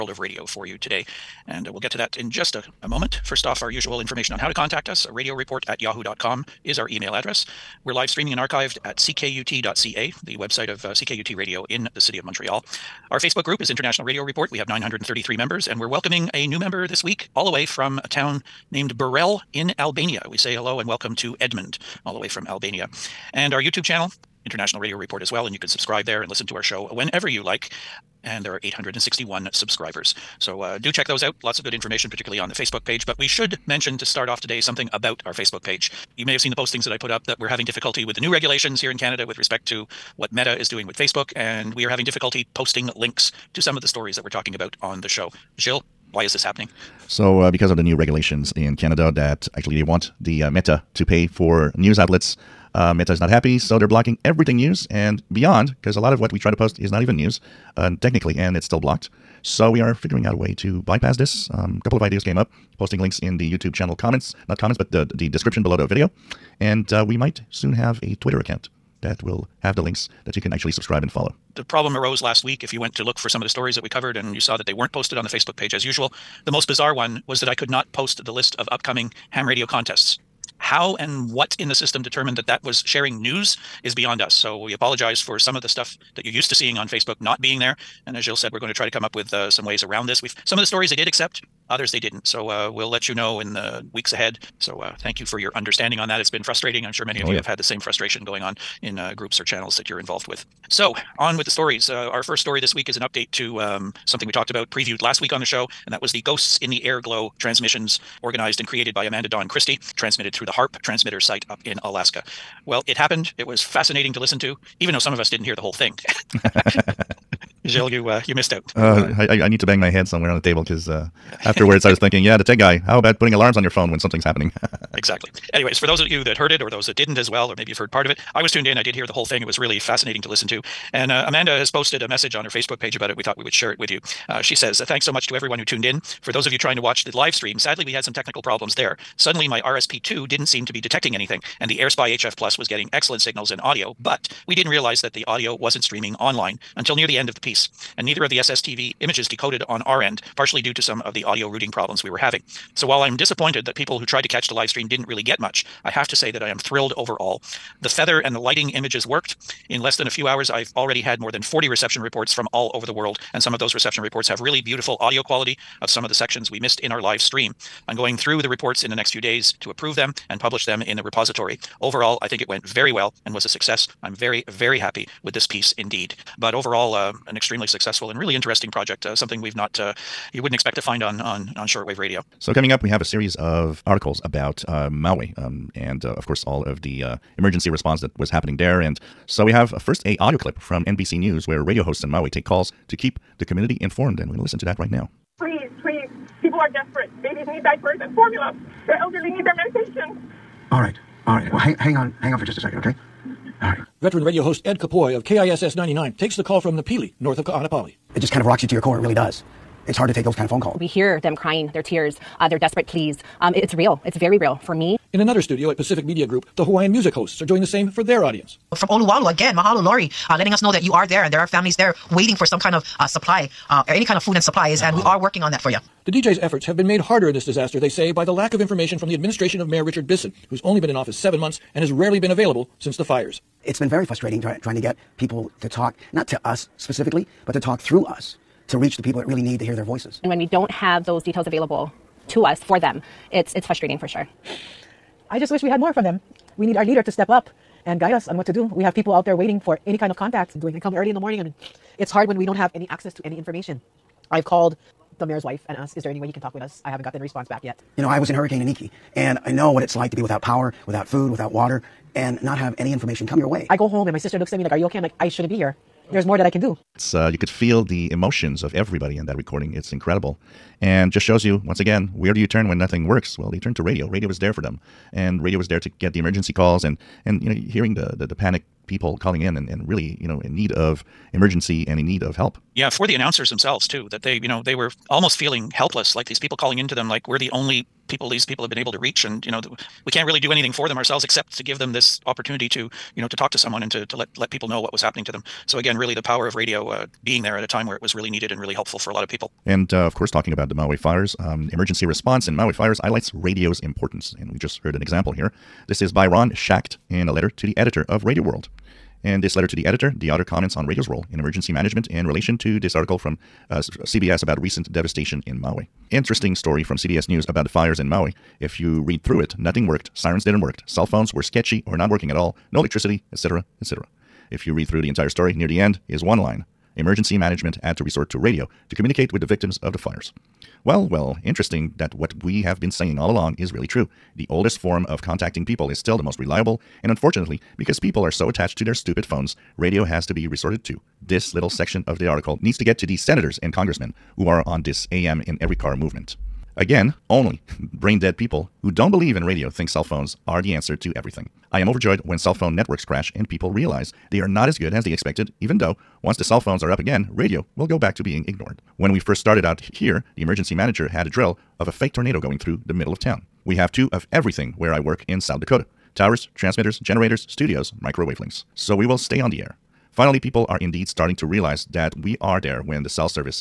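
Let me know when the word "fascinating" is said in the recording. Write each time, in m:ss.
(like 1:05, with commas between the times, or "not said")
1:53, 2:09.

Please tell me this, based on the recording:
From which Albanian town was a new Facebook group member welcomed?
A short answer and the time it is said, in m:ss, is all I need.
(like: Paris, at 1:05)
Burrel, at 0:18.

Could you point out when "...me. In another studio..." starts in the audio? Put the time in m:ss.
3:34.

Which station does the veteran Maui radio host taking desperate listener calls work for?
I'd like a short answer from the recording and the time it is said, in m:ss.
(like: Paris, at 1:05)
KISS 99, at 3:25.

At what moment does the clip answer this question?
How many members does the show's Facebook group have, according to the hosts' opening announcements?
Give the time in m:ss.
0:14.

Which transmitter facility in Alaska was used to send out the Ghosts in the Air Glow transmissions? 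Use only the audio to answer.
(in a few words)
HARP.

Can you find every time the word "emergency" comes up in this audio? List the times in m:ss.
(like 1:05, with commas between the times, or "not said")
3:07, 4:36, 4:41, 5:01, 5:11, 5:26, 6:00.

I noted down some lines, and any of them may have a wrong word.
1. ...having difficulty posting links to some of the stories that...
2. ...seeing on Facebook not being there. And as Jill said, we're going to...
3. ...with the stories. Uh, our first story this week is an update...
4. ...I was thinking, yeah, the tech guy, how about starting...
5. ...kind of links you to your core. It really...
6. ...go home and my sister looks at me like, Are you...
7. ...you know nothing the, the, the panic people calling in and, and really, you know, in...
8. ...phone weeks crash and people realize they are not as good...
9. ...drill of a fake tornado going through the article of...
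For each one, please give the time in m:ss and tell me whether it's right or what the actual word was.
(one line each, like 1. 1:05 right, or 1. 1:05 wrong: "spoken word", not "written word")
1. 0:41 right
2. 1:26 right
3. 1:41 right
4. 2:01 wrong: "putting", not "starting"
5. 3:28 wrong: "rocks", not "links"
6. 4:23 right
7. 4:37 wrong: "hearing", not "nothing"
8. 5:52 wrong: "networks", not "weeks"
9. 6:01 wrong: "middle", not "article".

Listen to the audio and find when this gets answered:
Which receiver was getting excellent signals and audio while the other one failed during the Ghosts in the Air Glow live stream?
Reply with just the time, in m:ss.
2:21.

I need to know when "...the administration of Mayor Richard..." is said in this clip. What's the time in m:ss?
3:49.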